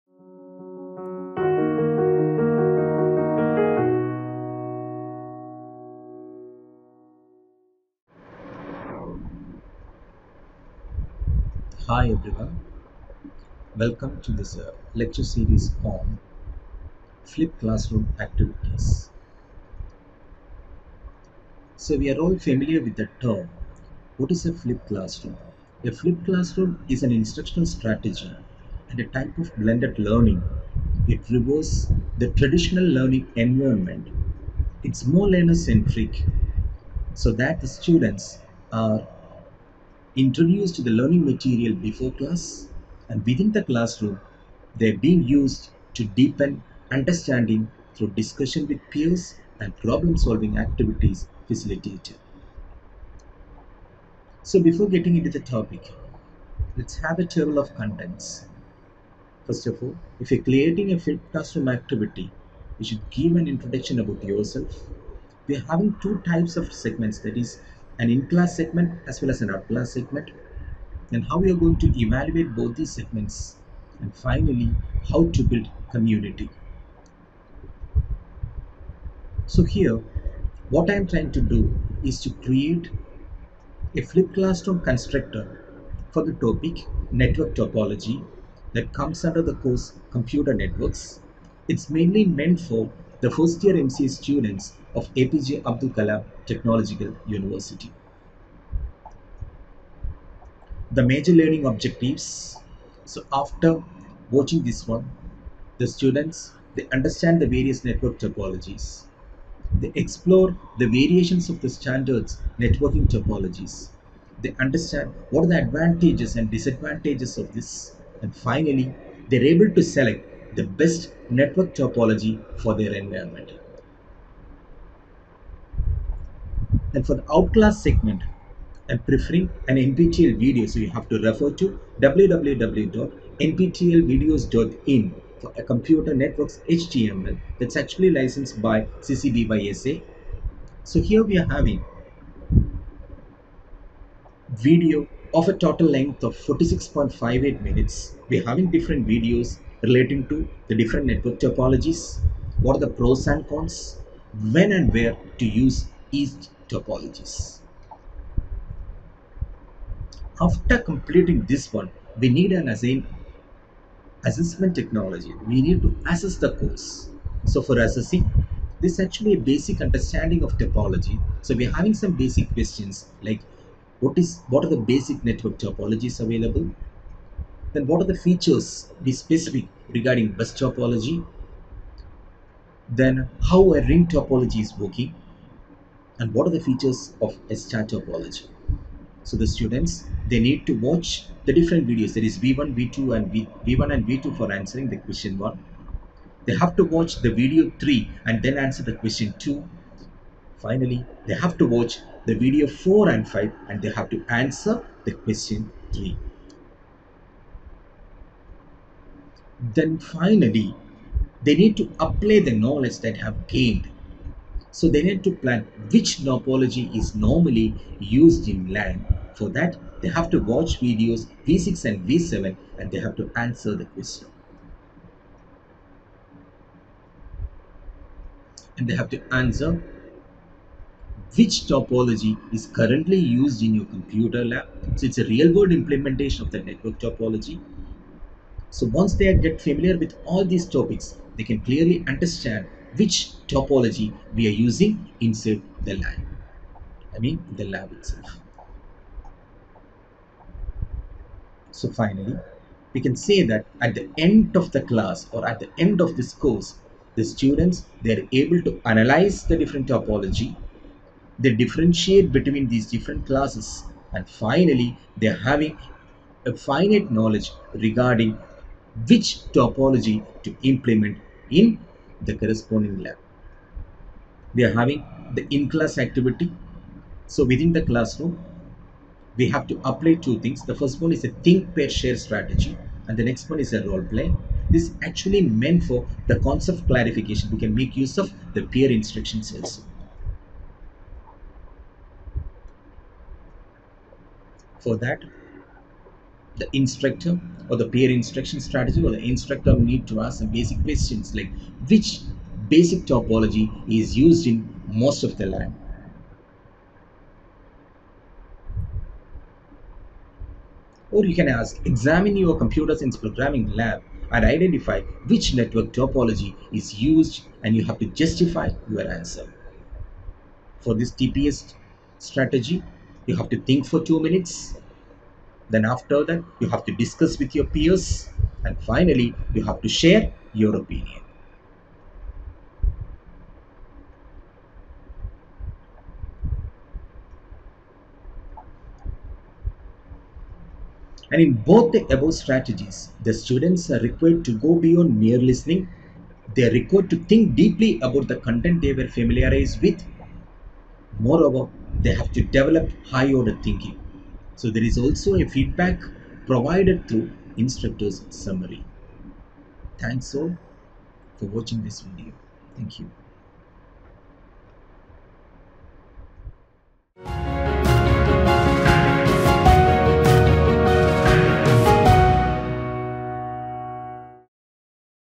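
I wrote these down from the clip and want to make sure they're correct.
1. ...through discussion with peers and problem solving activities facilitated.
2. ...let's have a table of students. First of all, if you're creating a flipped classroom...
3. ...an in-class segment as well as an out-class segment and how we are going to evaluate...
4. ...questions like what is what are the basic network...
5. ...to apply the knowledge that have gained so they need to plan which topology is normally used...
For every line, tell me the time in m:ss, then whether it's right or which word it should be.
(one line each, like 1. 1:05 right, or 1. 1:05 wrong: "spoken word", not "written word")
1. 0:47 right
2. 0:56 wrong: "contents", not "students"
3. 1:08 right
4. 2:52 right
5. 3:31 right.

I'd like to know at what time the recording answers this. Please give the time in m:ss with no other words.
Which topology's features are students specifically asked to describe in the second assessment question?
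3:00.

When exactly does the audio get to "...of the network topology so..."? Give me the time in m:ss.
3:56.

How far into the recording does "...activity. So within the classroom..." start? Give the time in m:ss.
4:35.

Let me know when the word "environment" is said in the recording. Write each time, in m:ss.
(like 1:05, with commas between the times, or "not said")
0:33, 2:02.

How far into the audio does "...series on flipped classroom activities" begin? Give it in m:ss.
0:15.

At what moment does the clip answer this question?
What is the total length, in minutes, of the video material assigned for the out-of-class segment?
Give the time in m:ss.
2:26.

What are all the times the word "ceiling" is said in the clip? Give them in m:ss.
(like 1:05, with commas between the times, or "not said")
not said.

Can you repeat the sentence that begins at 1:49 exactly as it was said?
They explore the variations of the standards networking topologies.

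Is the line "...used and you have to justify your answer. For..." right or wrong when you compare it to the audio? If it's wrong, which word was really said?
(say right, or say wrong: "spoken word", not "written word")
right.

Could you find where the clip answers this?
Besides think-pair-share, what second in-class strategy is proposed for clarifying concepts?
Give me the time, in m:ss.
4:43.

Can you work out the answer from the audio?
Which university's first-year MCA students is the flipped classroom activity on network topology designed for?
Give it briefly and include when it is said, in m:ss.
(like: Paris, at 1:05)
APJ Abdul Kalam Technological University, at 1:35.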